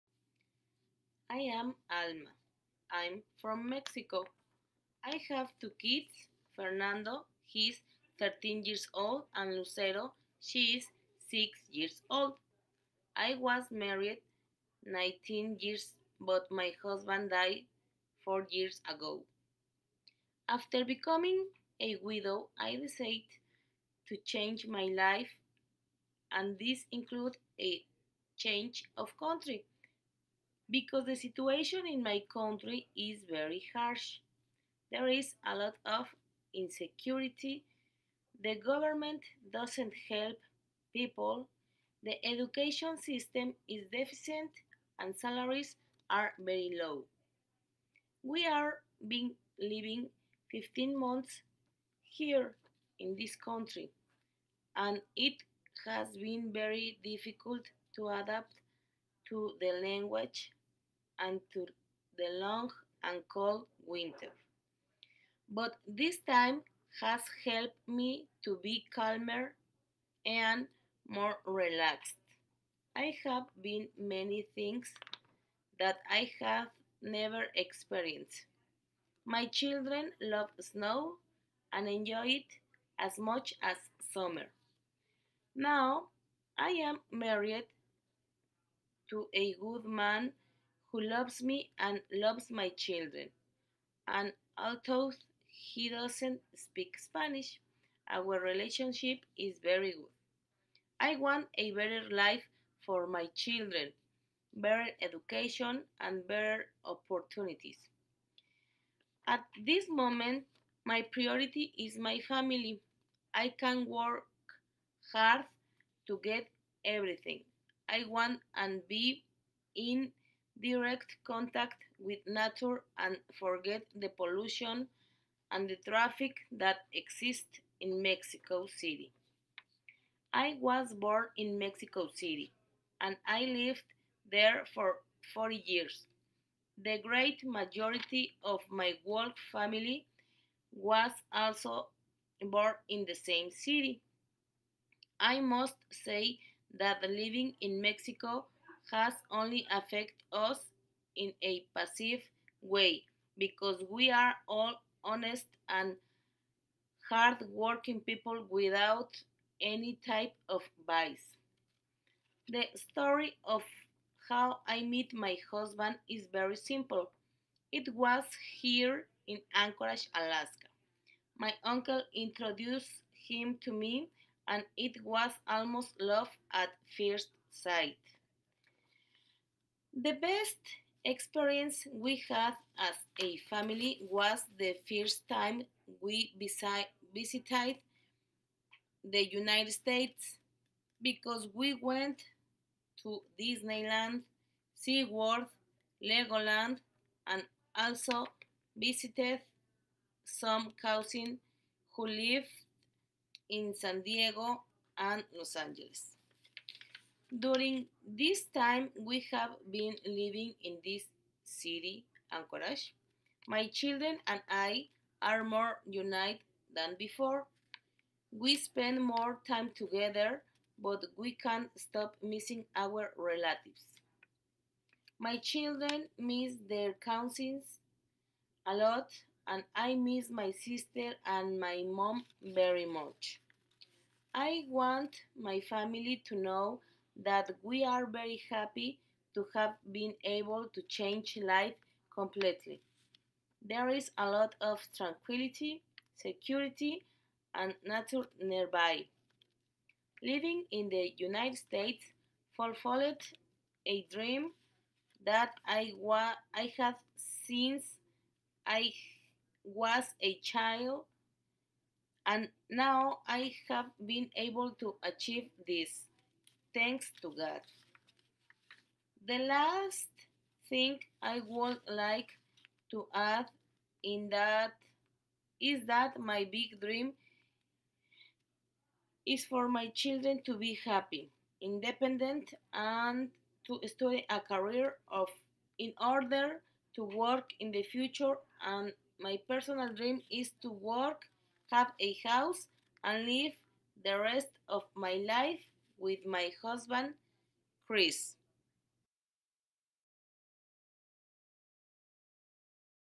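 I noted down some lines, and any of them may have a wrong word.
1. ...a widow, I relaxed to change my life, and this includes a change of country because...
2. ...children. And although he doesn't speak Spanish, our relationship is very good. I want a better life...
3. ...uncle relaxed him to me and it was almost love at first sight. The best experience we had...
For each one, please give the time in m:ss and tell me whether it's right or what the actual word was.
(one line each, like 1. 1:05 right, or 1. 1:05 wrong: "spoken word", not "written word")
1. 0:21 wrong: "decided", not "relaxed"
2. 1:32 right
3. 2:51 wrong: "introduced", not "relaxed".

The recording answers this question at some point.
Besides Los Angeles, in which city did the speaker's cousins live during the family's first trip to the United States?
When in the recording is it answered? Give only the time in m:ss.
3:23.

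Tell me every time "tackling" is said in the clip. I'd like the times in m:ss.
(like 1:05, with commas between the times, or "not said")
not said.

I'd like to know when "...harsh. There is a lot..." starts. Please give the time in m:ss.
0:33.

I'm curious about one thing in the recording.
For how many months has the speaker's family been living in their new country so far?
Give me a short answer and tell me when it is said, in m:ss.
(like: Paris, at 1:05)
15, at 0:50.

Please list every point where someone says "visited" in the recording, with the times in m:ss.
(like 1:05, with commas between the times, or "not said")
3:06, 3:18.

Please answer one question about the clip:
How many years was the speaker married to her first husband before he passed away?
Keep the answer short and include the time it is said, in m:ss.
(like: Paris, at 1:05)
19, at 0:14.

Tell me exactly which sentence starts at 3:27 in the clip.
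During this time we have been living in this city, Anchorage, my children and I are more united than before.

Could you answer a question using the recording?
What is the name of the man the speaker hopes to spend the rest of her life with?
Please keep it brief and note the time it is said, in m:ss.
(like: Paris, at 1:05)
Chris, at 4:57.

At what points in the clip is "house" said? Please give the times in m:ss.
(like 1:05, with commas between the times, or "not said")
4:52.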